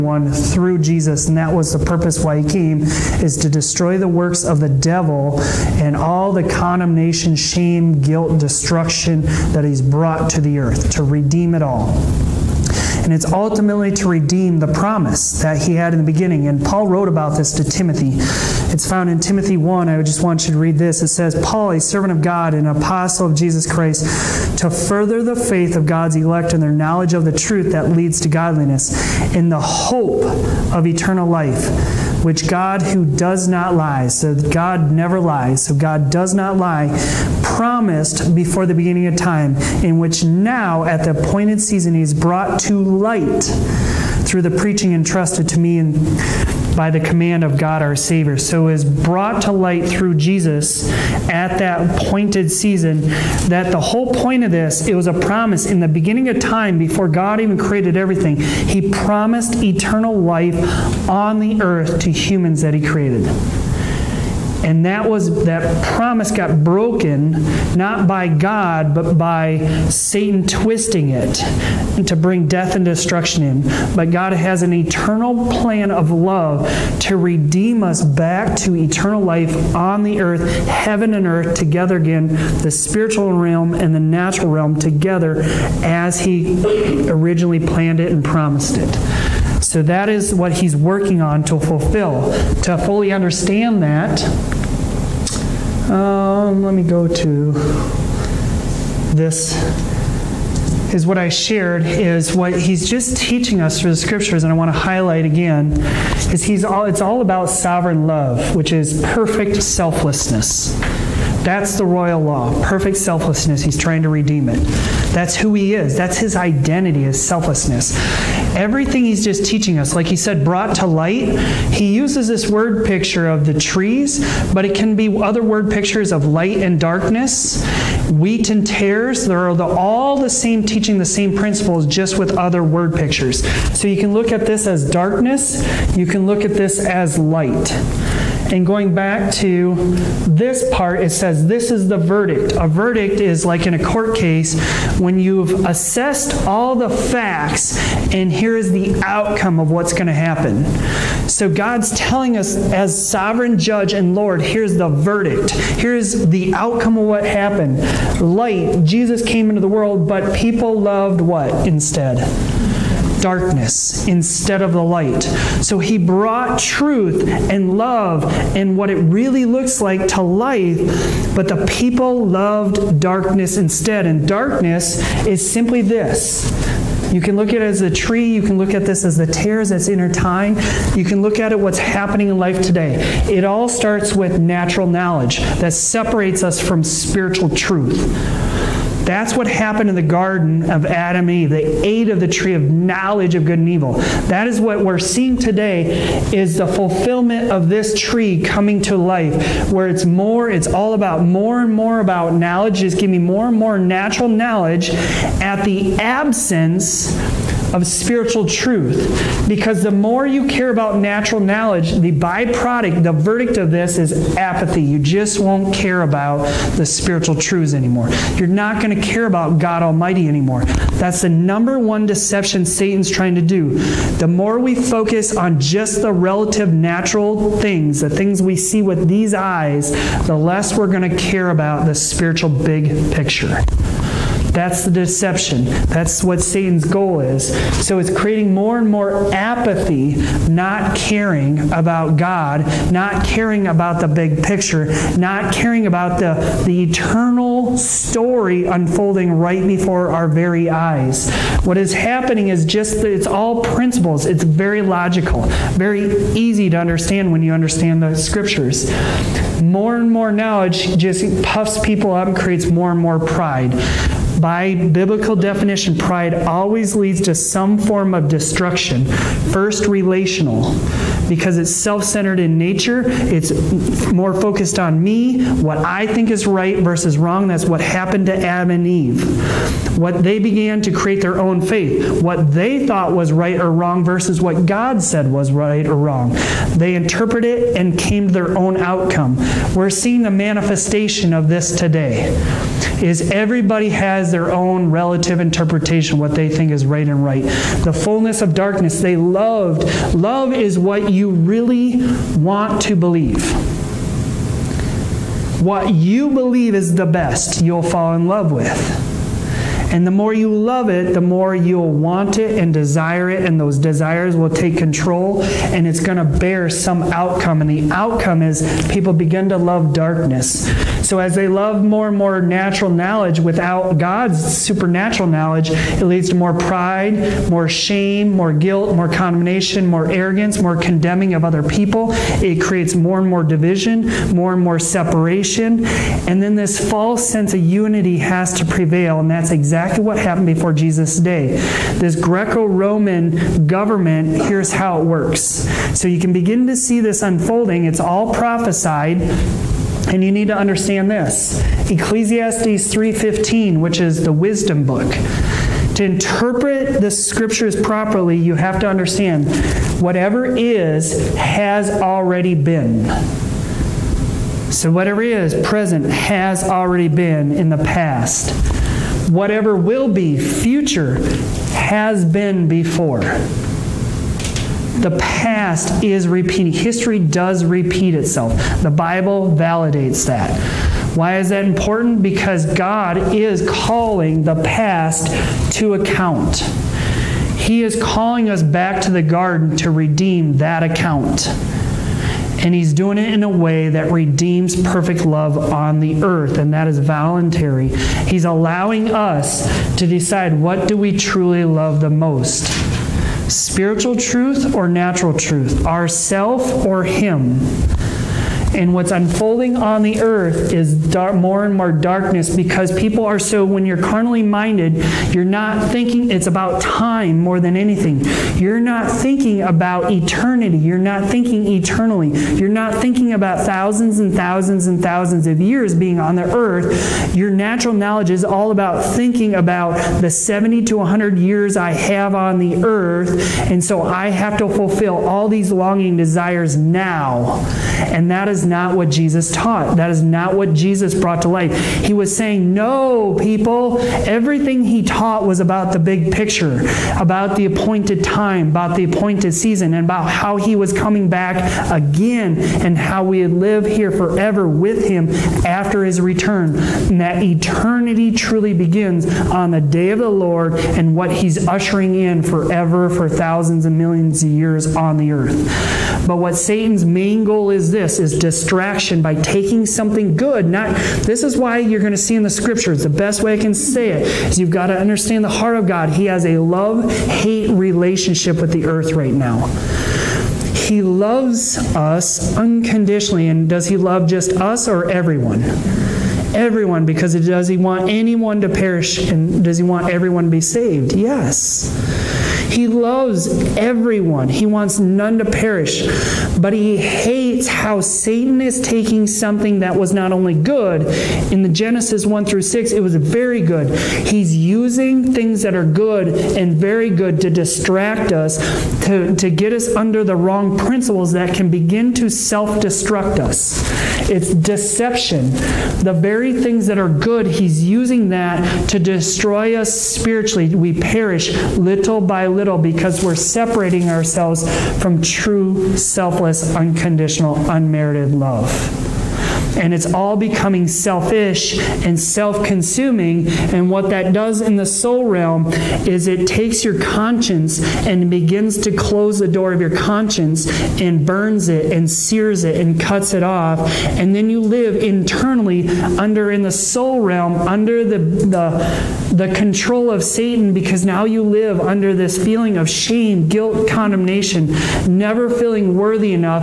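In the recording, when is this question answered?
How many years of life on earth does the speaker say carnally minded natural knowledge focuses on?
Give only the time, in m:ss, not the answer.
7:10.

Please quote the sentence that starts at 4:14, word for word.
It's very logical, very easy to understand when you understand the scriptures.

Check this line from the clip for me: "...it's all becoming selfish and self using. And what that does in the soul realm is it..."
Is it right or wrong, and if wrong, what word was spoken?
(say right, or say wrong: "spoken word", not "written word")
wrong: "consuming", not "using".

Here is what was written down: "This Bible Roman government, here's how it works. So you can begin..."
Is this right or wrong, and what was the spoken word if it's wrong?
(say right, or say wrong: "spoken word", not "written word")
wrong: "Greco", not "Bible".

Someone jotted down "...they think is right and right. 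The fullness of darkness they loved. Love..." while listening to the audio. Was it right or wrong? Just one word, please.
right.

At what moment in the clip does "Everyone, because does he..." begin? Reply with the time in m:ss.
8:06.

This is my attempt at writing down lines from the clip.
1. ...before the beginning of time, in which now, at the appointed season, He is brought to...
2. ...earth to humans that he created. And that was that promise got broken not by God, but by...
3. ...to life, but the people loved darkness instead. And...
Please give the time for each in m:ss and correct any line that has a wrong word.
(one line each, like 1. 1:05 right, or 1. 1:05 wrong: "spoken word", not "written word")
1. 0:38 right
2. 1:01 right
3. 2:50 right.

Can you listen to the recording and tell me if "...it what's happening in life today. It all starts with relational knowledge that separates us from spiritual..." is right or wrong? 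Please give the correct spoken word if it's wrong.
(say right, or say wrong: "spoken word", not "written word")
wrong: "natural", not "relational".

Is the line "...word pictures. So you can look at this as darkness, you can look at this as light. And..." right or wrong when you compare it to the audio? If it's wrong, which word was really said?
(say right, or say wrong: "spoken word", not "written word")
right.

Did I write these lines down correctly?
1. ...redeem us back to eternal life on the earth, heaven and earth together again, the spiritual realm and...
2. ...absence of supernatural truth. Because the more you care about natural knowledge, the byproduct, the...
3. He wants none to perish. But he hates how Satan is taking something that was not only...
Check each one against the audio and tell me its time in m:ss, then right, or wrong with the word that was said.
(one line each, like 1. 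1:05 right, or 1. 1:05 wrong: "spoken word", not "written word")
1. 1:17 right
2. 3:25 wrong: "spiritual", not "supernatural"
3. 8:14 right.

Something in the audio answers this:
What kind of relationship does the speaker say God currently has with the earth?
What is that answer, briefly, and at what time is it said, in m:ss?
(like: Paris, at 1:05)
Love-hate, at 7:56.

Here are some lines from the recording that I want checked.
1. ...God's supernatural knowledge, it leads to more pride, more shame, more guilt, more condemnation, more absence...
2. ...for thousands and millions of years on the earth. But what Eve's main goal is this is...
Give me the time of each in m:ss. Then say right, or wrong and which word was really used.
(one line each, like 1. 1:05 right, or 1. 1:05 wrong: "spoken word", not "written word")
1. 5:23 wrong: "arrogance", not "absence"
2. 7:43 wrong: "Satan", not "Eve".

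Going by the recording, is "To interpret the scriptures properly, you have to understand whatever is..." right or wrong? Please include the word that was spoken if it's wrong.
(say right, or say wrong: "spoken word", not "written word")
right.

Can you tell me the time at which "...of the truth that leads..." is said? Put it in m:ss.
0:27.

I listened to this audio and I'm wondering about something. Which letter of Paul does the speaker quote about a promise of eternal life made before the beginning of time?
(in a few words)
1 Timothy.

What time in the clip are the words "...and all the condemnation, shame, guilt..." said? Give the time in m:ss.
0:05.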